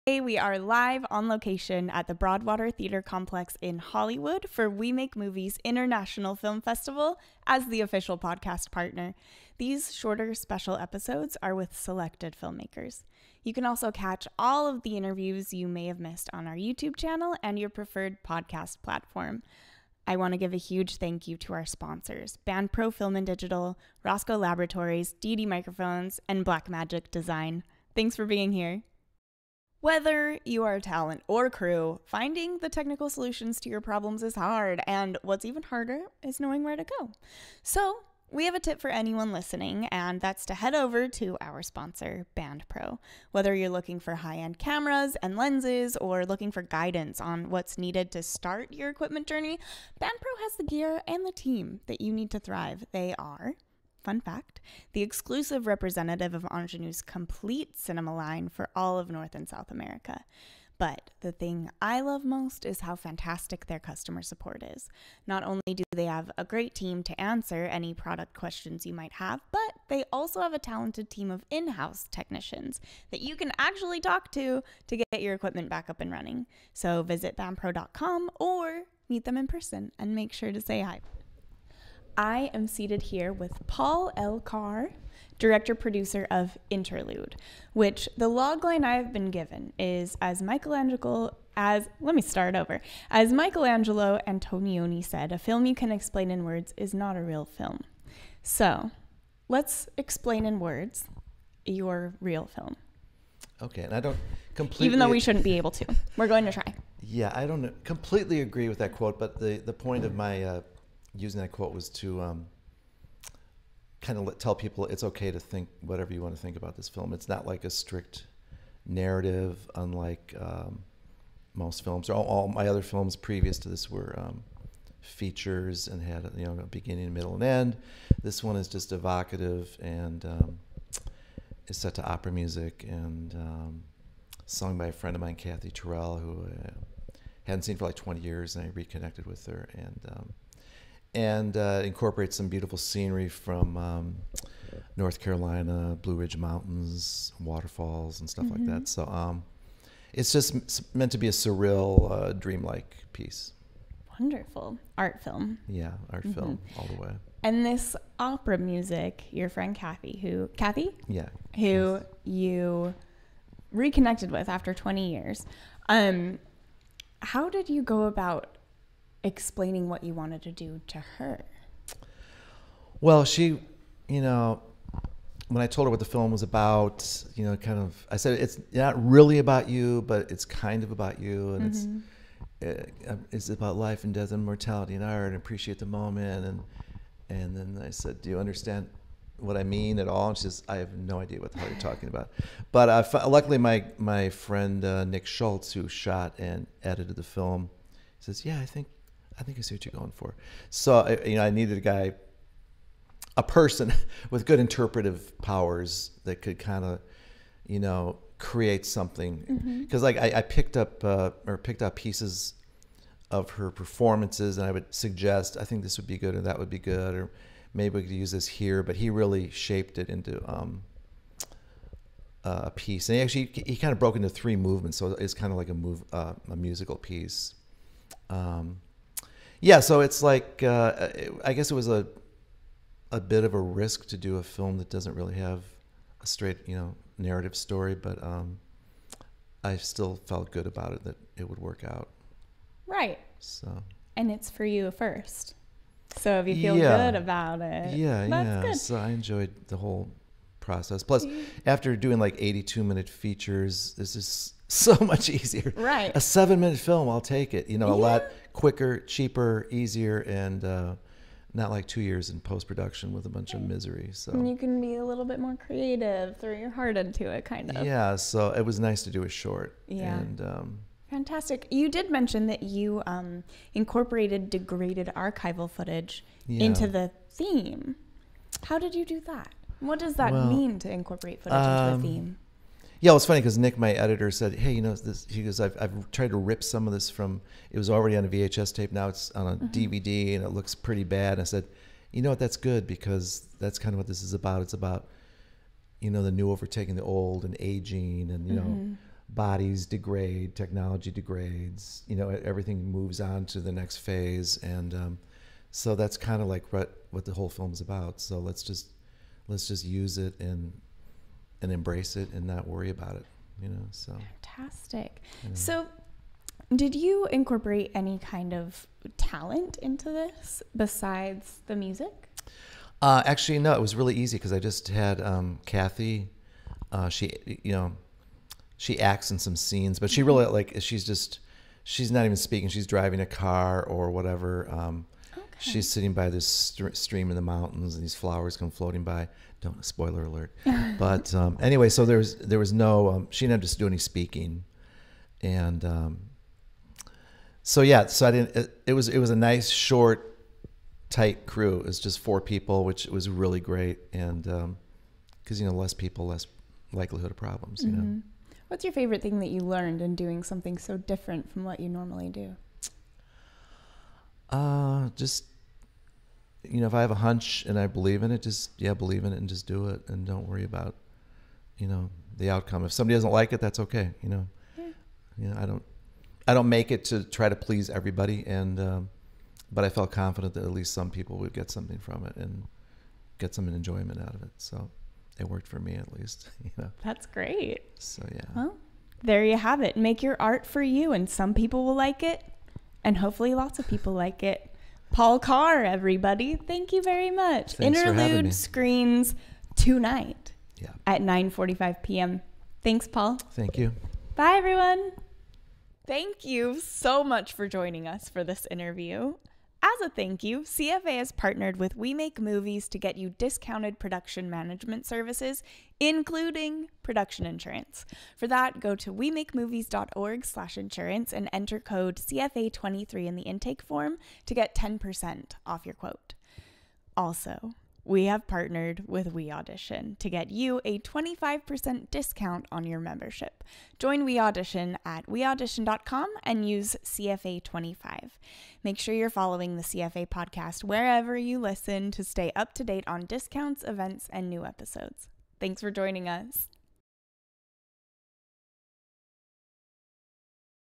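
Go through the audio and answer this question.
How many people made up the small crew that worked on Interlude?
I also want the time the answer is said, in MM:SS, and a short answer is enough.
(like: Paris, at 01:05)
4, at 05:52.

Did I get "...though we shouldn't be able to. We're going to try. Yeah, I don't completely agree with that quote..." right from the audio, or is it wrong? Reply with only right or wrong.
right.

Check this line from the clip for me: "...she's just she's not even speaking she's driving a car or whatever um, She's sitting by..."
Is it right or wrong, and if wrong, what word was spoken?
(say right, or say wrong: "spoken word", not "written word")
right.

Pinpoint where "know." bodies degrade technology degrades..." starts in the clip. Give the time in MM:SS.
04:58.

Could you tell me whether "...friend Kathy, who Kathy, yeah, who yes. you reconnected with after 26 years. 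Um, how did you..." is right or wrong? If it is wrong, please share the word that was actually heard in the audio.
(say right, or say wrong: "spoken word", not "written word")
wrong: "20", not "26".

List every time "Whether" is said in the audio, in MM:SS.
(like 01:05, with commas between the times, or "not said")
00:29, 00:43.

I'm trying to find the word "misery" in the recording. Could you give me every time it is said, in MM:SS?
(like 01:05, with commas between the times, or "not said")
04:23.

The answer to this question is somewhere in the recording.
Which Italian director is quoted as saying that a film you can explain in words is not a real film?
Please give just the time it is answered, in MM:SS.
01:33.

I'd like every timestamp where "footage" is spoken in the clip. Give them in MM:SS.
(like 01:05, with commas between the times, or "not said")
04:35, 04:41.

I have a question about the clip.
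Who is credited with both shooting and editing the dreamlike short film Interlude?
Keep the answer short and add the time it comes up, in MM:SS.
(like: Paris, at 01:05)
Nick Schultz, at 03:15.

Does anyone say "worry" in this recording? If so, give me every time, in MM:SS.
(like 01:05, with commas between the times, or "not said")
05:12, 06:10.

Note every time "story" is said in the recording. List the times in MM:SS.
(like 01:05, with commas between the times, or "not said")
03:57.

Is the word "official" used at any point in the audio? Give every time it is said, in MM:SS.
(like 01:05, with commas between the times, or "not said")
00:07.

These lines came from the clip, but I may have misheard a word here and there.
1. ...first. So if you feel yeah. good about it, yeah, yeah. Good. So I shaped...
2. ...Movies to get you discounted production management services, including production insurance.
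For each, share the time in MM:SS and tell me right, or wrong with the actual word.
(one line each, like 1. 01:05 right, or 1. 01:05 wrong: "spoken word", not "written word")
1. 04:04 wrong: "enjoyed", not "shaped"
2. 06:52 right.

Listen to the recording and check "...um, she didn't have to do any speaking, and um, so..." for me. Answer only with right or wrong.
right.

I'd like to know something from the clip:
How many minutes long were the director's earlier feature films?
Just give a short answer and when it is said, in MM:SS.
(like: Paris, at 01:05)
82, at 04:12.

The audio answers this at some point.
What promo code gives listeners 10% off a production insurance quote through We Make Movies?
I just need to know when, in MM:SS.
07:02.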